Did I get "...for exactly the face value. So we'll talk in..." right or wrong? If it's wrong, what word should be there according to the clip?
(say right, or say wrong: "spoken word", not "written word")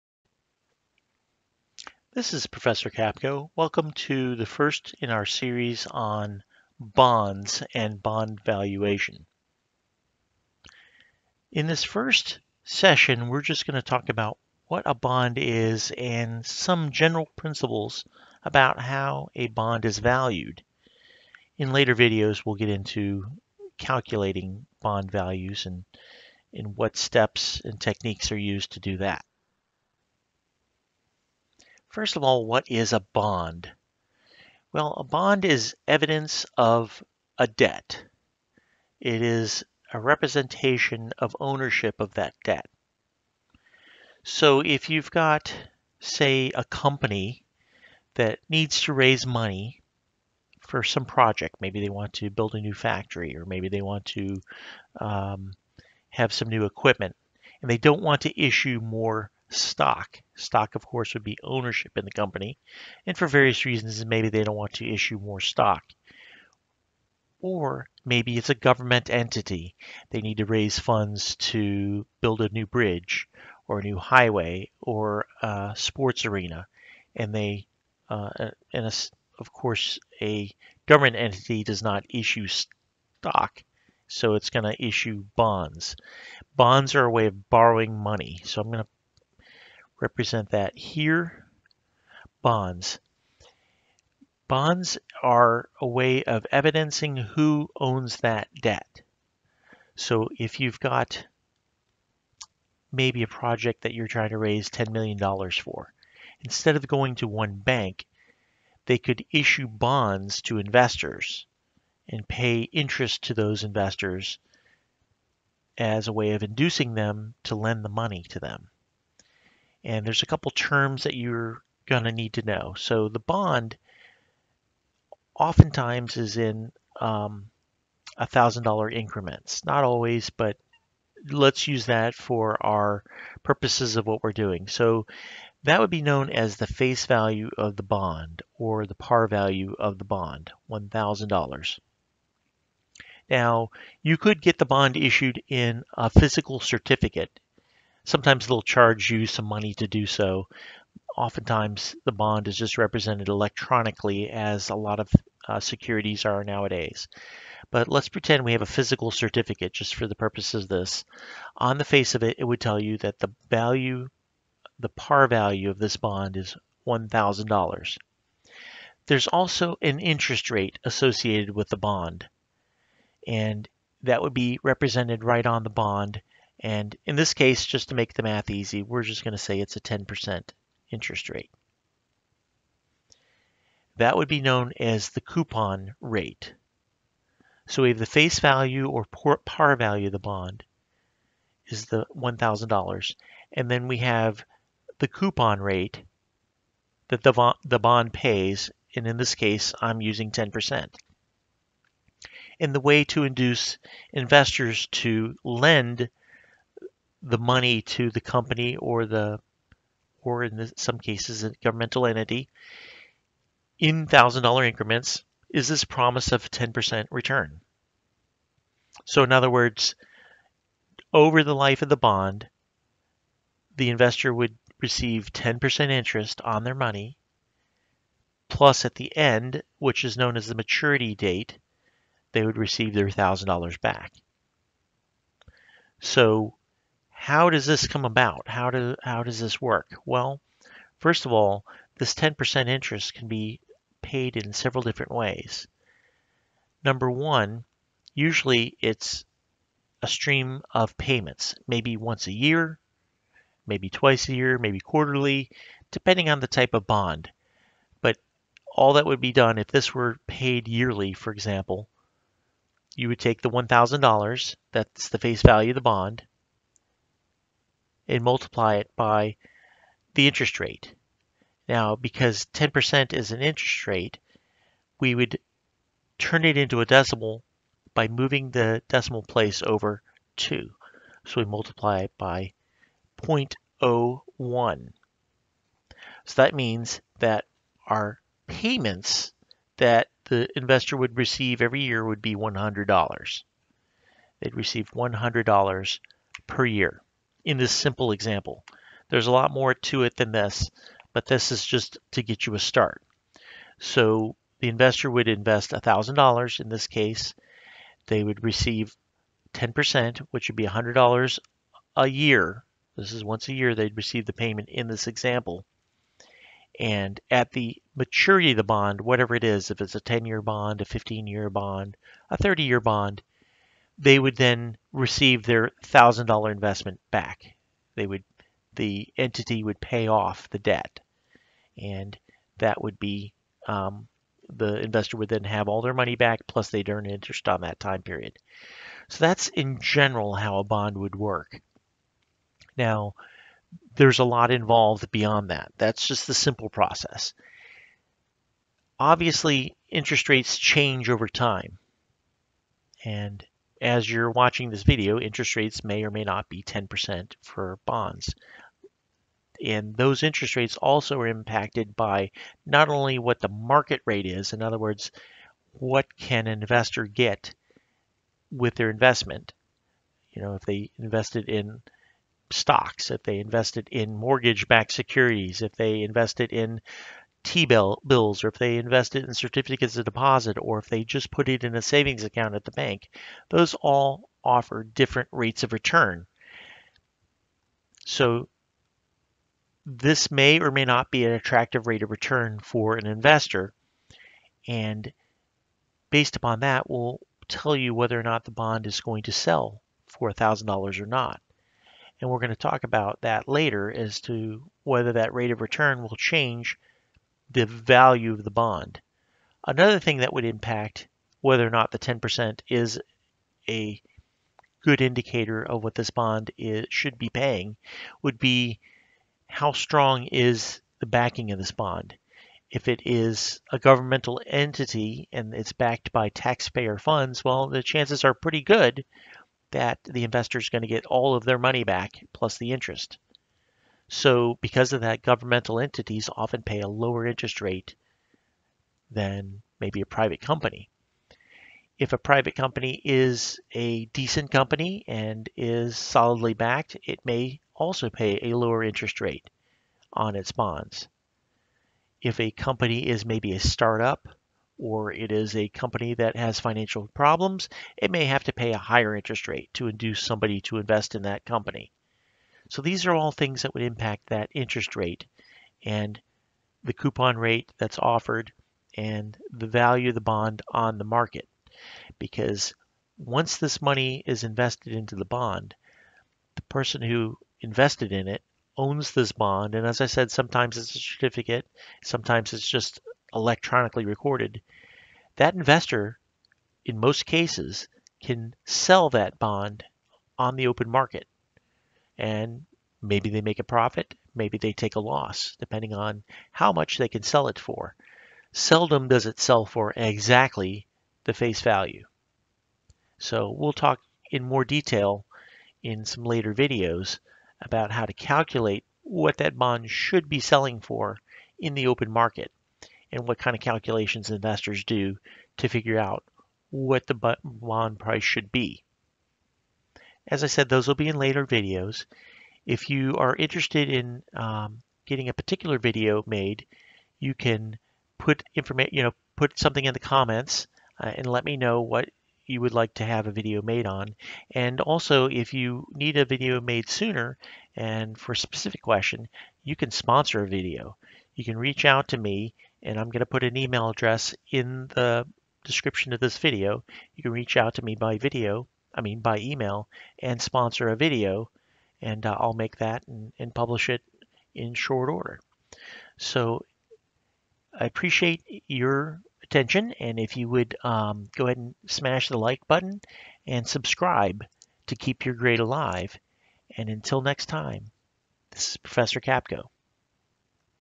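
right.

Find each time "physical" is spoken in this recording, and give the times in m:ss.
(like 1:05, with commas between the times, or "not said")
2:26, 2:38.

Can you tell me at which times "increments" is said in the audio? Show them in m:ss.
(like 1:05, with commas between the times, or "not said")
2:08, 3:34.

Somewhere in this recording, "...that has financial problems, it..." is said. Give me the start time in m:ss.
7:36.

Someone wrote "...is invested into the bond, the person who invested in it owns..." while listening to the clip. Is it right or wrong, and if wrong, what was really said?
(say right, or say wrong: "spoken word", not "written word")
right.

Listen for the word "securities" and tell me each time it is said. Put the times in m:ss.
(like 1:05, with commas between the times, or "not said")
2:35, 6:14.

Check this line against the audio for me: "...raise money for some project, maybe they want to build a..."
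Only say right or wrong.
right.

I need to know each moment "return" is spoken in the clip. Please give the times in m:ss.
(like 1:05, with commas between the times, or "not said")
3:37, 6:25, 6:32, 6:45.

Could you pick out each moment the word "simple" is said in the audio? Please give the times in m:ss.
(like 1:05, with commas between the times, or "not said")
4:57, 5:46.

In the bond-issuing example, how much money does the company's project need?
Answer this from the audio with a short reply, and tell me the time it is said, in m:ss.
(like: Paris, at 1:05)
$10 million, at 1:44.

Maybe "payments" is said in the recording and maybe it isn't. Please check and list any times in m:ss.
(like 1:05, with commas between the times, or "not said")
4:10, 4:48, 5:14.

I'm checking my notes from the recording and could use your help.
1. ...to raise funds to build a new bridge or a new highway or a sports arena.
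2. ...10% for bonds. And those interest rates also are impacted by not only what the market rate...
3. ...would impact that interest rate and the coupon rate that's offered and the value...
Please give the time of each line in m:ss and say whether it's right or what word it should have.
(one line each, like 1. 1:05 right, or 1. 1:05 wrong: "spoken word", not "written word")
1. 1:10 right
2. 5:56 right
3. 7:43 right.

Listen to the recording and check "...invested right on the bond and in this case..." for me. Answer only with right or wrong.
wrong.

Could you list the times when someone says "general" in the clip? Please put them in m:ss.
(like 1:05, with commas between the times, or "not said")
0:16, 5:39.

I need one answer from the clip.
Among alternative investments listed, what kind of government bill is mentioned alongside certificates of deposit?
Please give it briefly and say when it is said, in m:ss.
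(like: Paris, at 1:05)
T-bills, at 6:17.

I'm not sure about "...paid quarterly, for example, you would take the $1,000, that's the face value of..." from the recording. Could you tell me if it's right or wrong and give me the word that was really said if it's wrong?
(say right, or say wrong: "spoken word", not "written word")
wrong: "yearly", not "quarterly".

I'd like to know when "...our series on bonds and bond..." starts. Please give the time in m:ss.
0:05.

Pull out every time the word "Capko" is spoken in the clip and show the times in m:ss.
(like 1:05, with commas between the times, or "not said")
0:02, 9:29.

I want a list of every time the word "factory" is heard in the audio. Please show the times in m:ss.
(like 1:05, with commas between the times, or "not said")
0:52.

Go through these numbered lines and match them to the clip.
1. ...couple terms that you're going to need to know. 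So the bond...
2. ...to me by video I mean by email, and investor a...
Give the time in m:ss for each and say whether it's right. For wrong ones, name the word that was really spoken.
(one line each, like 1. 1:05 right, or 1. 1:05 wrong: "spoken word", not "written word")
1. 2:00 right
2. 9:07 wrong: "sponsor", not "investor".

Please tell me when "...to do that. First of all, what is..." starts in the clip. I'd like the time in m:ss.
0:28.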